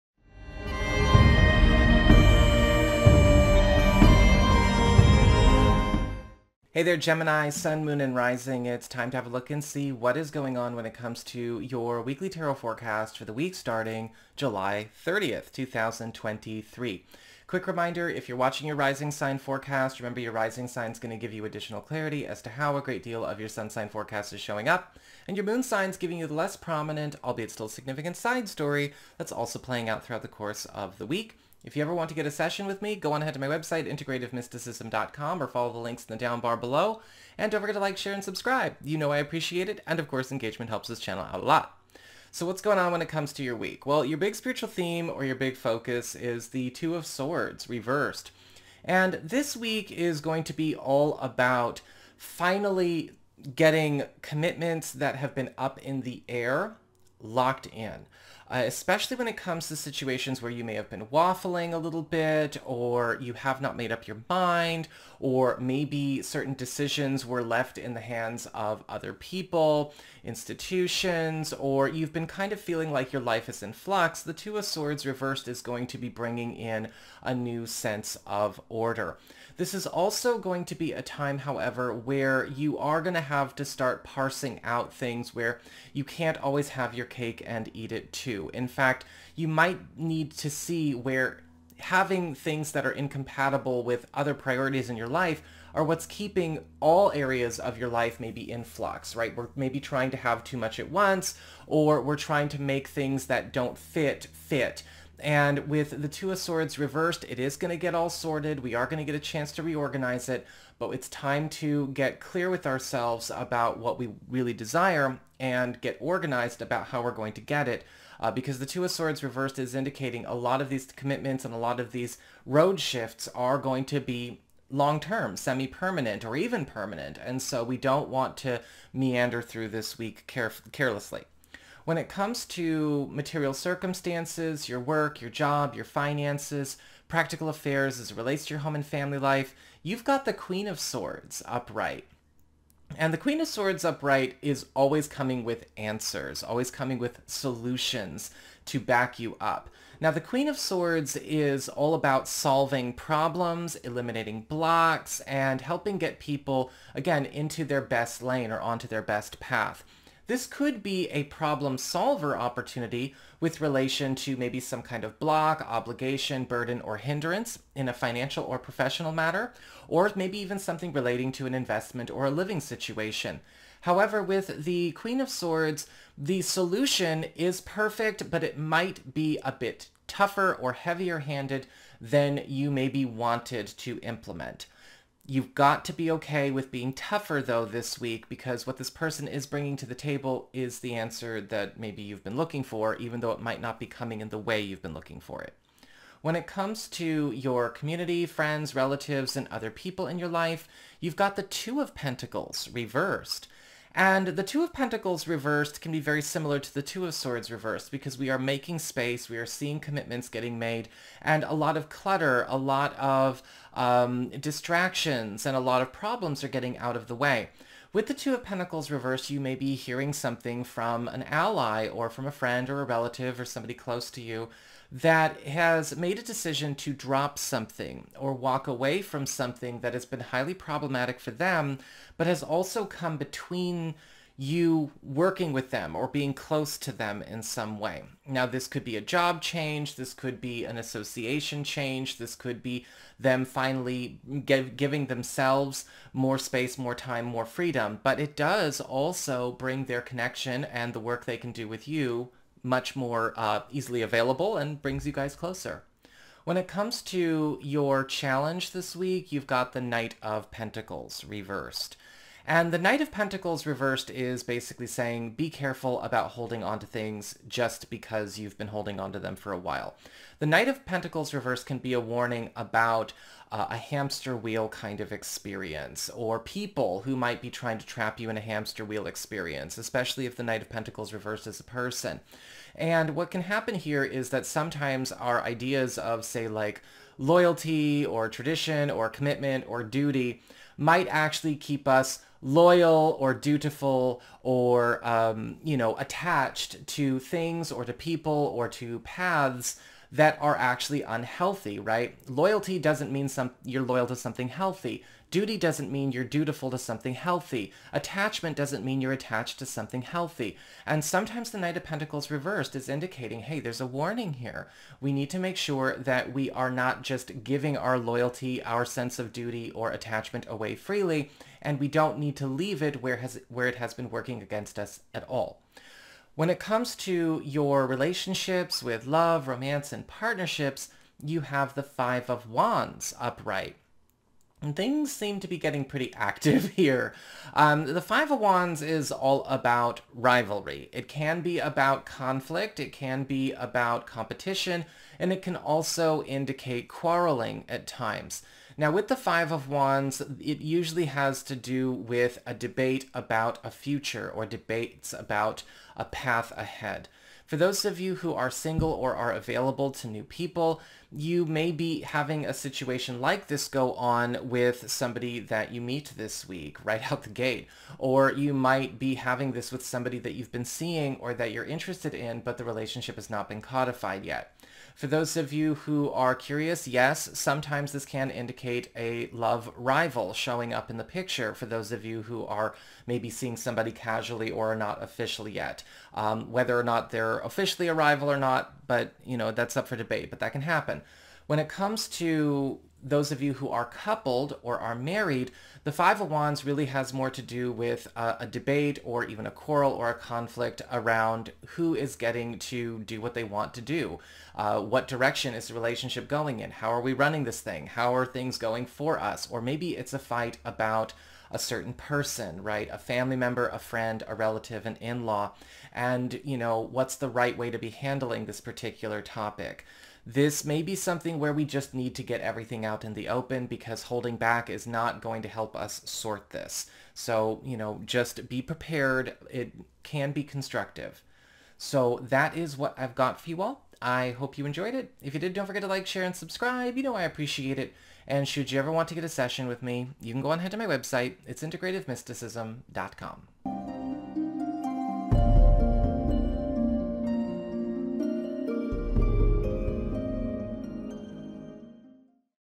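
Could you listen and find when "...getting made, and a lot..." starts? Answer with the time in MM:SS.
03:30.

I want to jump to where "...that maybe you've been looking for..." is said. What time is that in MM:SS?
03:11.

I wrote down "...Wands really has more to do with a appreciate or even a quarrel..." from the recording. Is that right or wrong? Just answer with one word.
wrong.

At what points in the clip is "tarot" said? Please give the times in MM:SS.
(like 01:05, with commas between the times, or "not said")
00:12.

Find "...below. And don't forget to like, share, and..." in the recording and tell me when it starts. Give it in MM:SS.
00:36.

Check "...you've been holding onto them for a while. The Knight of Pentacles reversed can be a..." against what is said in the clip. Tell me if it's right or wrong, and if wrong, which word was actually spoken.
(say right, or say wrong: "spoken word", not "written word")
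right.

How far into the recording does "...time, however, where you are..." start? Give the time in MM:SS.
01:21.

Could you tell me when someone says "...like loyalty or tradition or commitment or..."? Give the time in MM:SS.
04:46.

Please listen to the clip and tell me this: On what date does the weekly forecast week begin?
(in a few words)
July 30th, 2023.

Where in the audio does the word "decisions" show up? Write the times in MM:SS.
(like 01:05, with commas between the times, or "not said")
01:06, 03:46.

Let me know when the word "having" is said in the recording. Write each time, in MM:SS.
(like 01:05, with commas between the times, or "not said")
01:31, 06:01, 06:09.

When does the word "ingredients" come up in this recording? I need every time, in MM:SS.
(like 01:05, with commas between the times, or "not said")
not said.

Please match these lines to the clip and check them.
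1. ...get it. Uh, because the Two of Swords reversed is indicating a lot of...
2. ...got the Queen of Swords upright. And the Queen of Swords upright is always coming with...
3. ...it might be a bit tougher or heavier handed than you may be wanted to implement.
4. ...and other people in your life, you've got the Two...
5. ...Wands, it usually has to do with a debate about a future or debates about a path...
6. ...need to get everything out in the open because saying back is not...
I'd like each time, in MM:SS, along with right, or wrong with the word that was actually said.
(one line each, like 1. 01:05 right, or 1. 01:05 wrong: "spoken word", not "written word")
1. 01:57 right
2. 02:20 right
3. 02:58 right
4. 03:19 right
5. 05:49 right
6. 07:01 wrong: "holding", not "saying".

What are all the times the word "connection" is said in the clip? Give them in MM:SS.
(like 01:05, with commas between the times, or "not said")
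04:10.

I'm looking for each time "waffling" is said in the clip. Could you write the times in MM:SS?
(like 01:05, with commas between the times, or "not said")
01:01.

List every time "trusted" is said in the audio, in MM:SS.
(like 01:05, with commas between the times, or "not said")
not said.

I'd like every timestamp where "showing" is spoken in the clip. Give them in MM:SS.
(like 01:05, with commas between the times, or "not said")
00:24, 06:20.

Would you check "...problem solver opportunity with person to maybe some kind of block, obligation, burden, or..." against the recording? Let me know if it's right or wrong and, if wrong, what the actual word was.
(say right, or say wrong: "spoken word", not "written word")
wrong: "relation", not "person".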